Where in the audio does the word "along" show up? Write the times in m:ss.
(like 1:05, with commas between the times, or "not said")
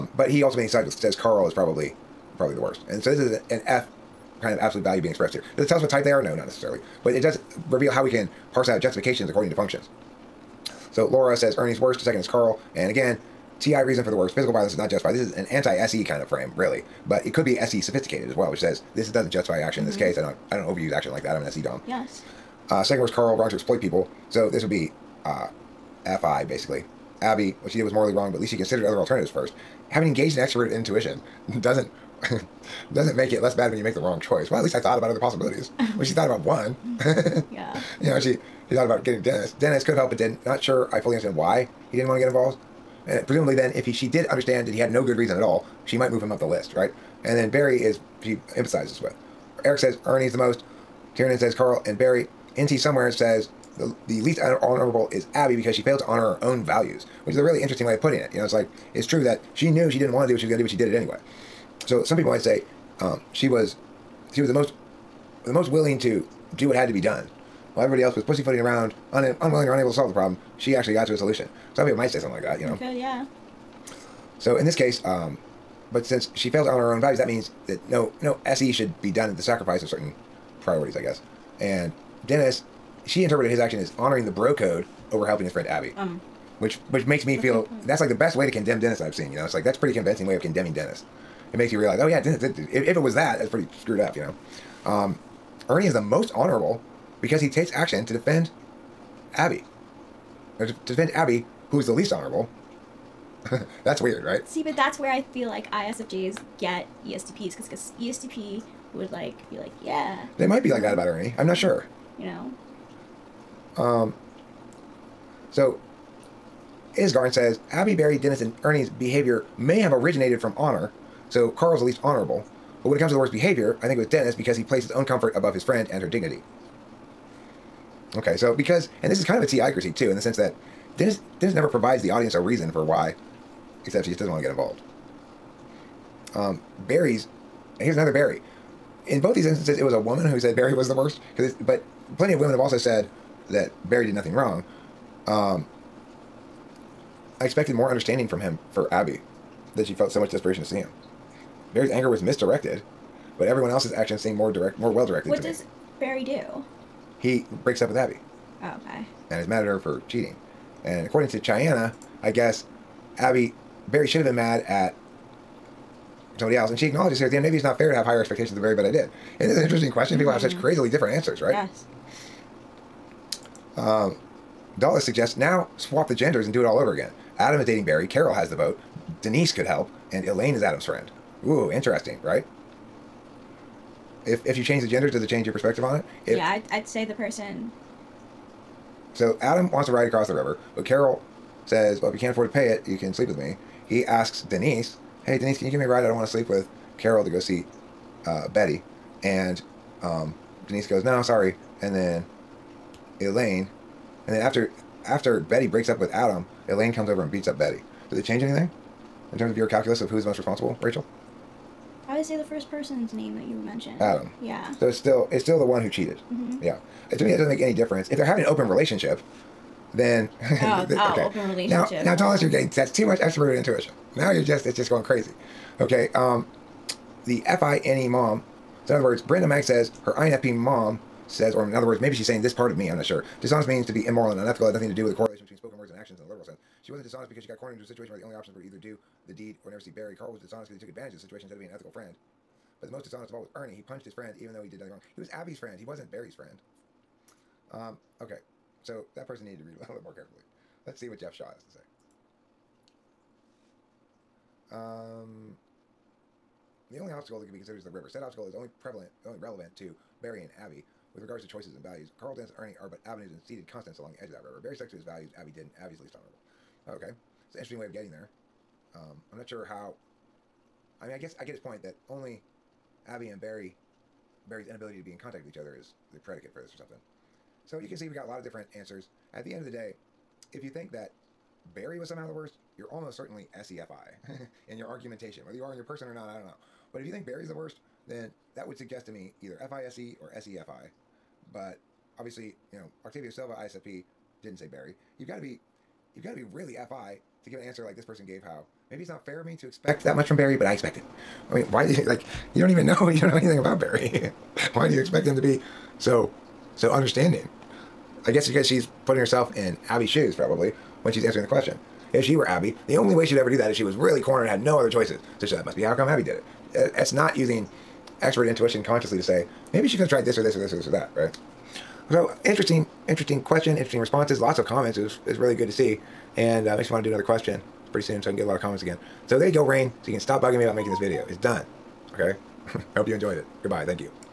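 4:23.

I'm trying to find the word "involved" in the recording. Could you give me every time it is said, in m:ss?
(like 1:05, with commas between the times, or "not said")
0:42, 2:14.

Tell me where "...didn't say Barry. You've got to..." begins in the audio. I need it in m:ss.
4:54.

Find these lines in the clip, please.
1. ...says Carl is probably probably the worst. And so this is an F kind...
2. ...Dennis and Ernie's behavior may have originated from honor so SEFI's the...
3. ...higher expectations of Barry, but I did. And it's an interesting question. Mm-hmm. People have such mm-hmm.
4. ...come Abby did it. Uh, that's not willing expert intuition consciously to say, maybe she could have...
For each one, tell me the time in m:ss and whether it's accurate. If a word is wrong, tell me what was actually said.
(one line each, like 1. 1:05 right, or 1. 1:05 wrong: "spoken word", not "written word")
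1. 0:00 right
2. 1:58 wrong: "Carl", not "SEFI"
3. 2:48 right
4. 5:15 wrong: "using", not "willing".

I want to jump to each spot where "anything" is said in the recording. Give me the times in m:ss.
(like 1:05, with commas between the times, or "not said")
3:28, 5:03.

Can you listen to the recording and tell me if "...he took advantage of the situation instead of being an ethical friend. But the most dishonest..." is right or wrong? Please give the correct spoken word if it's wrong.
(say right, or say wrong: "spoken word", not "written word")
right.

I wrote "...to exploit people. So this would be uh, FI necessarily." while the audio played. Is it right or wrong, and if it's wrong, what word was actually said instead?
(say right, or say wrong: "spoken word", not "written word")
wrong: "basically", not "necessarily".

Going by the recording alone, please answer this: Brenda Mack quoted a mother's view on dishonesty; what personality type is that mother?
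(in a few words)
INFP.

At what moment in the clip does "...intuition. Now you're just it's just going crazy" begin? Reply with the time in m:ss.
3:43.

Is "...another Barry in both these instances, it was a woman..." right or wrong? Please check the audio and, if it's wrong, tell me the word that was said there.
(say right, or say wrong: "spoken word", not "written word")
right.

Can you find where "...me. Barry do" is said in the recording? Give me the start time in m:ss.
2:35.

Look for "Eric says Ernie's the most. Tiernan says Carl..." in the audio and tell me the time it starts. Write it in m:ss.
0:49.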